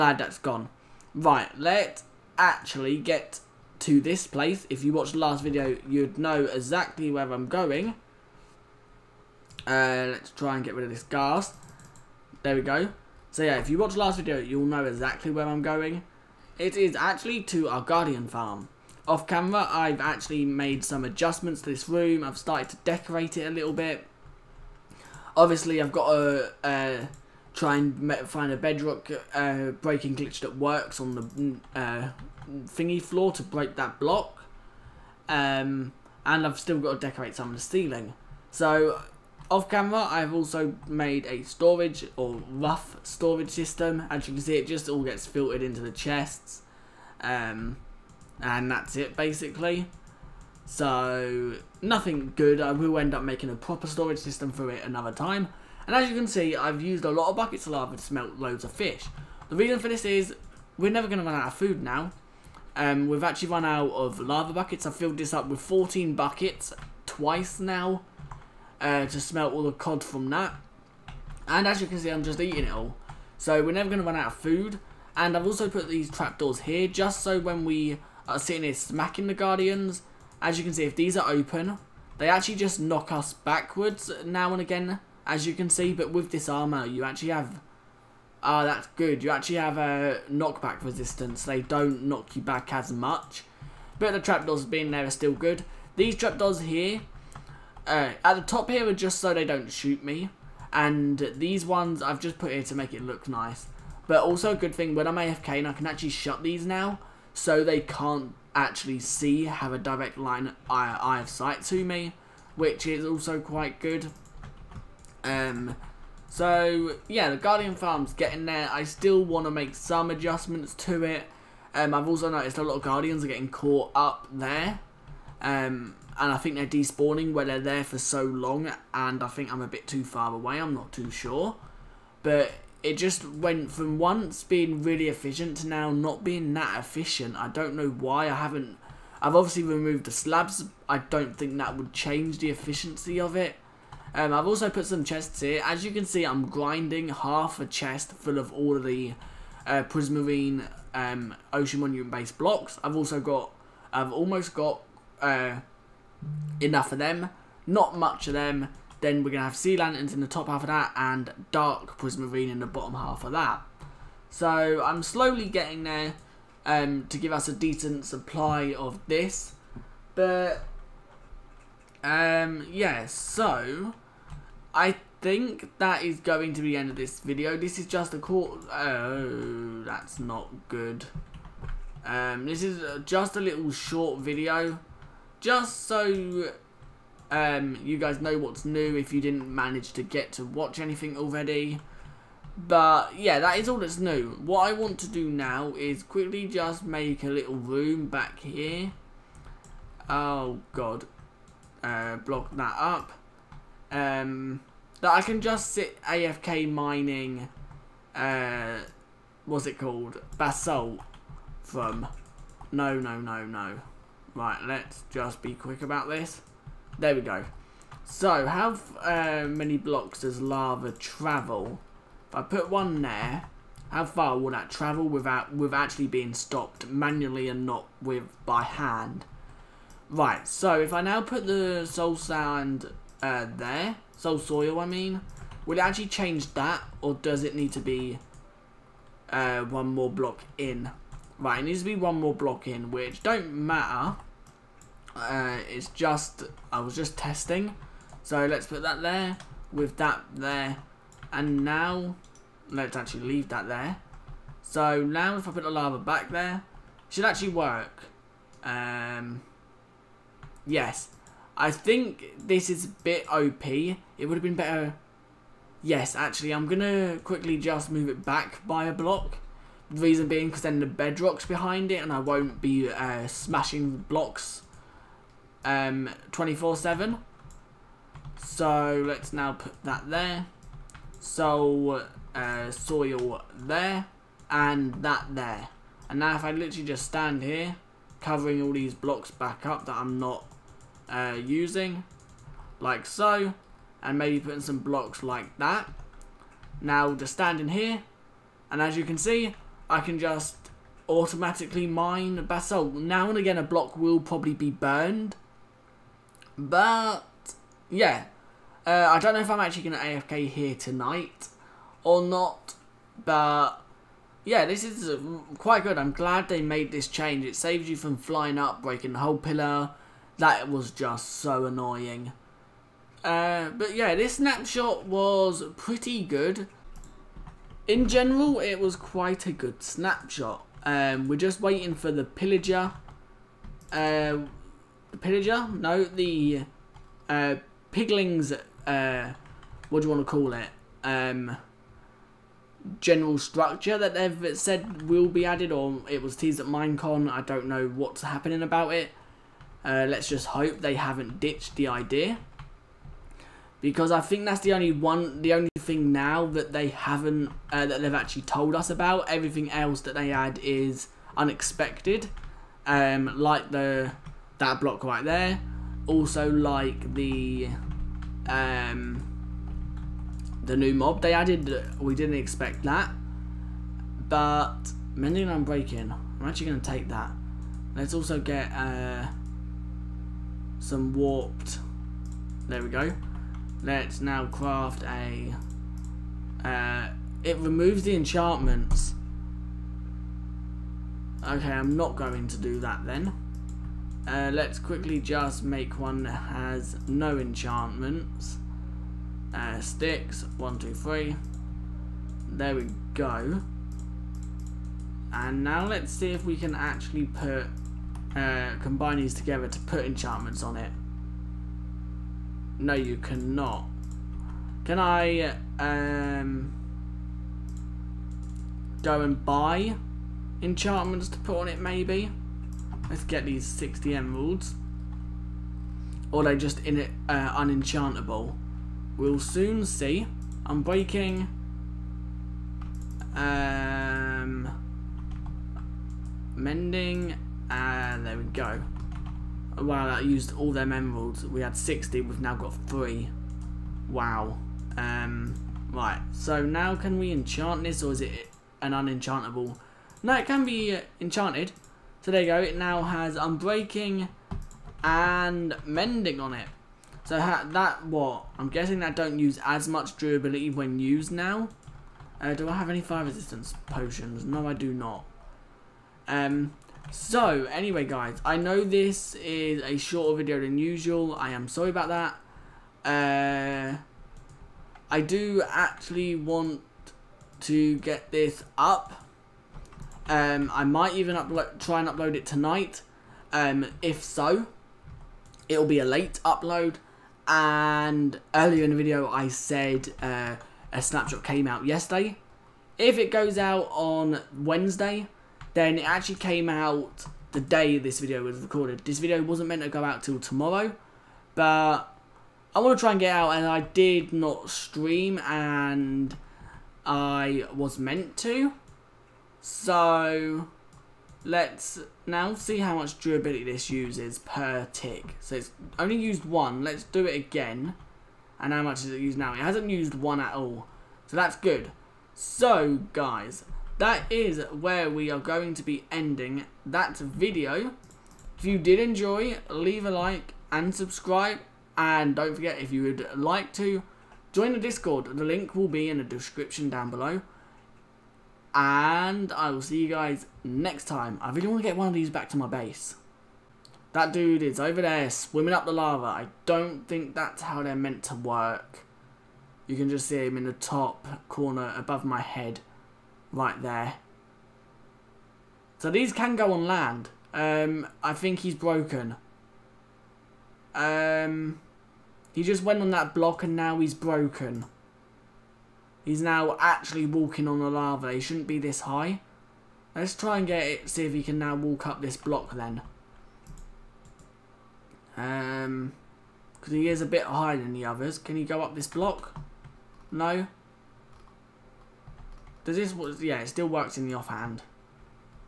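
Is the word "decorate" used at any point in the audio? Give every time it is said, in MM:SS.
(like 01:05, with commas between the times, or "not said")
00:22, 00:37.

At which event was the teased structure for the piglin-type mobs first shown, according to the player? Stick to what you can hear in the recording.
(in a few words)
Minecon.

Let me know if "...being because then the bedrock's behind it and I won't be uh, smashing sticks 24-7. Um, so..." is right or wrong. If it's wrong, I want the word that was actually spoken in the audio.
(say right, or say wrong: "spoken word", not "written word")
wrong: "blocks", not "sticks".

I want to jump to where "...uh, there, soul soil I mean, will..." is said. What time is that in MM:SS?
03:53.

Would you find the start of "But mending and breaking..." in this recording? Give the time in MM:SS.
06:14.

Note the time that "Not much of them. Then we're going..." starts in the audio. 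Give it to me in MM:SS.
02:37.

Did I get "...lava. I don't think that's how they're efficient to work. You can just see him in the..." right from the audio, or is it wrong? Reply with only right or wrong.
wrong.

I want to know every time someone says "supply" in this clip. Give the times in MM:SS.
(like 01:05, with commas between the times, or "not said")
02:48.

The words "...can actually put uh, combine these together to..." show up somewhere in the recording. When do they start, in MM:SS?
06:46.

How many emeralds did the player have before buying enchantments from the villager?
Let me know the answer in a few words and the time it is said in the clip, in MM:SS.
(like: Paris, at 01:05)
60, at 07:03.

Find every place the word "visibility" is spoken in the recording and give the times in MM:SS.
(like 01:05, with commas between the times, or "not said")
not said.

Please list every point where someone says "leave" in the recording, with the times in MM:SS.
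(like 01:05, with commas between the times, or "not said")
04:13, 08:49.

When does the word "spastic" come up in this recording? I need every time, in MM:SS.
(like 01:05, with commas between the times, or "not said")
not said.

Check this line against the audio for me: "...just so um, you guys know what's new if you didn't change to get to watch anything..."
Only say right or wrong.
wrong.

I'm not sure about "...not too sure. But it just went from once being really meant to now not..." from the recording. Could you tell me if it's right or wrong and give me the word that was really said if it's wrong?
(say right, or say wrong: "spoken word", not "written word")
wrong: "efficient", not "meant".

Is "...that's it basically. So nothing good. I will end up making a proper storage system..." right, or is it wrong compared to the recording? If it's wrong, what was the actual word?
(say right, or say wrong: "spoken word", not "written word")
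right.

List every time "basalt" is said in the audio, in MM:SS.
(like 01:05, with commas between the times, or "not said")
03:30, 05:02.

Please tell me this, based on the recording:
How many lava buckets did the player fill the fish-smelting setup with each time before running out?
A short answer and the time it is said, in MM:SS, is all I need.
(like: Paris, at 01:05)
14, at 01:05.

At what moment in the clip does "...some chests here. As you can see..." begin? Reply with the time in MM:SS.
02:24.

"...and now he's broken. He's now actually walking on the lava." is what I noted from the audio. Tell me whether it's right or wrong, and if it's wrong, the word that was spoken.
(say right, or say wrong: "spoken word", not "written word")
right.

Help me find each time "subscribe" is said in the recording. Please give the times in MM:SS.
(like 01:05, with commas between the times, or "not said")
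08:50.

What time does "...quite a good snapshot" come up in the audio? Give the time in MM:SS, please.
05:28.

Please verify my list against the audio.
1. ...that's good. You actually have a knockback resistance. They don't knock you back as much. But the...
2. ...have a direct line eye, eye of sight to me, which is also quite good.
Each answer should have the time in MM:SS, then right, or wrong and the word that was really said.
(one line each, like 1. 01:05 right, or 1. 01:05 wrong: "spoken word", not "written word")
1. 01:28 right
2. 01:49 right.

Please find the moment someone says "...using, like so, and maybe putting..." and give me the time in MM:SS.
04:51.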